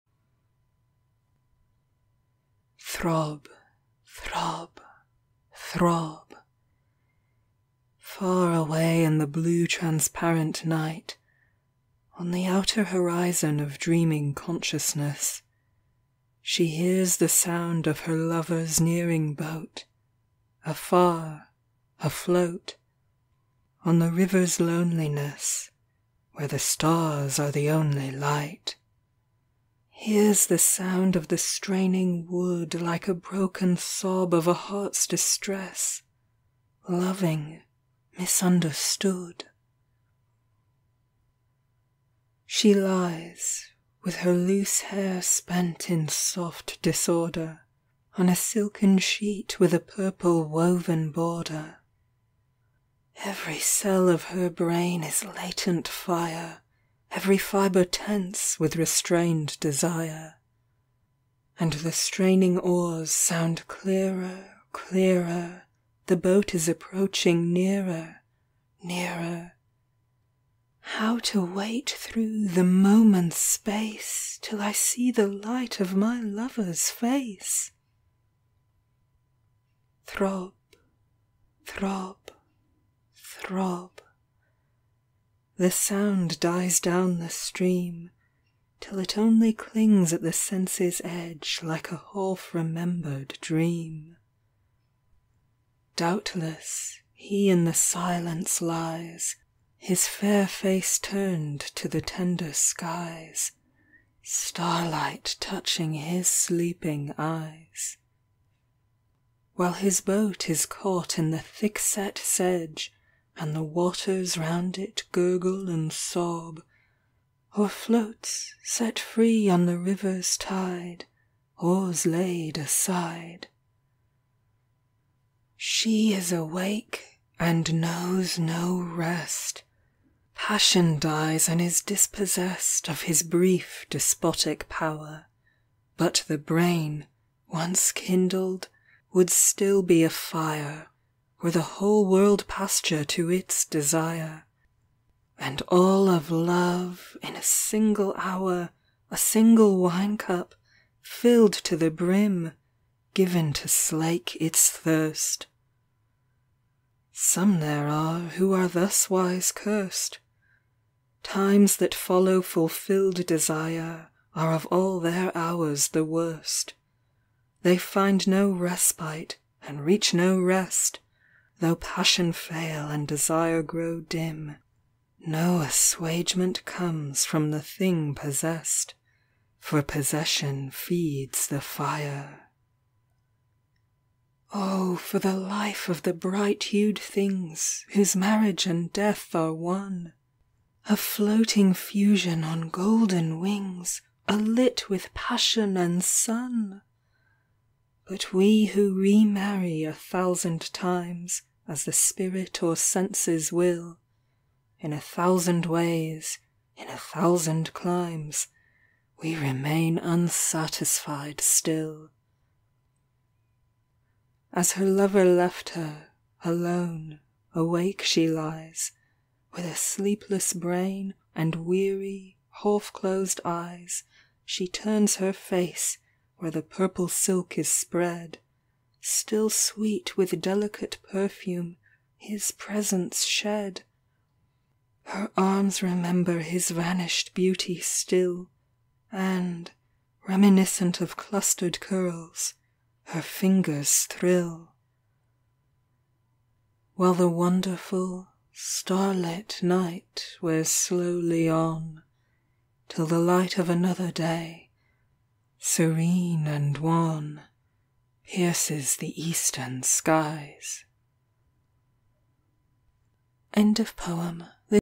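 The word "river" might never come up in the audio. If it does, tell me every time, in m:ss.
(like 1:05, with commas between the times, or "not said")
0:24, 1:59.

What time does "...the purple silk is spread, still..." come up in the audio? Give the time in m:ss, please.
3:46.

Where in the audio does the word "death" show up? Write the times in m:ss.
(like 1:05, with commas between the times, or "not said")
3:08.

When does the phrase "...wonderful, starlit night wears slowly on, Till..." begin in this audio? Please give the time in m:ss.
4:07.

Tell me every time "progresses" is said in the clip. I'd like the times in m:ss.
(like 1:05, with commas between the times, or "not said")
not said.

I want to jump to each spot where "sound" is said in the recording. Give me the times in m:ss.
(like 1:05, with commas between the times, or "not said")
0:17, 0:30, 1:03, 1:25.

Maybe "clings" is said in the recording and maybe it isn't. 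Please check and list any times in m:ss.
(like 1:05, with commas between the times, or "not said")
1:29.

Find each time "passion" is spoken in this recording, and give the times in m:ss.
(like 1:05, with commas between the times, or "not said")
2:10, 2:51, 3:15.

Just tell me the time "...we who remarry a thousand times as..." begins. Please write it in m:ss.
3:18.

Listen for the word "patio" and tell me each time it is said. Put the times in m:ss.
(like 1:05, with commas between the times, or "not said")
not said.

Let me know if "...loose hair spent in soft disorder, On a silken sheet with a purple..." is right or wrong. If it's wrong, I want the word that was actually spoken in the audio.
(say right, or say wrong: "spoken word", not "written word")
right.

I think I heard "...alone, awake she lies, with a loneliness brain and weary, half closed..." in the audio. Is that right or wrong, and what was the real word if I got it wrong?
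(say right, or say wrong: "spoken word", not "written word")
wrong: "sleepless", not "loneliness".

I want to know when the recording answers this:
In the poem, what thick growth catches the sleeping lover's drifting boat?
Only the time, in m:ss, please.
1:51.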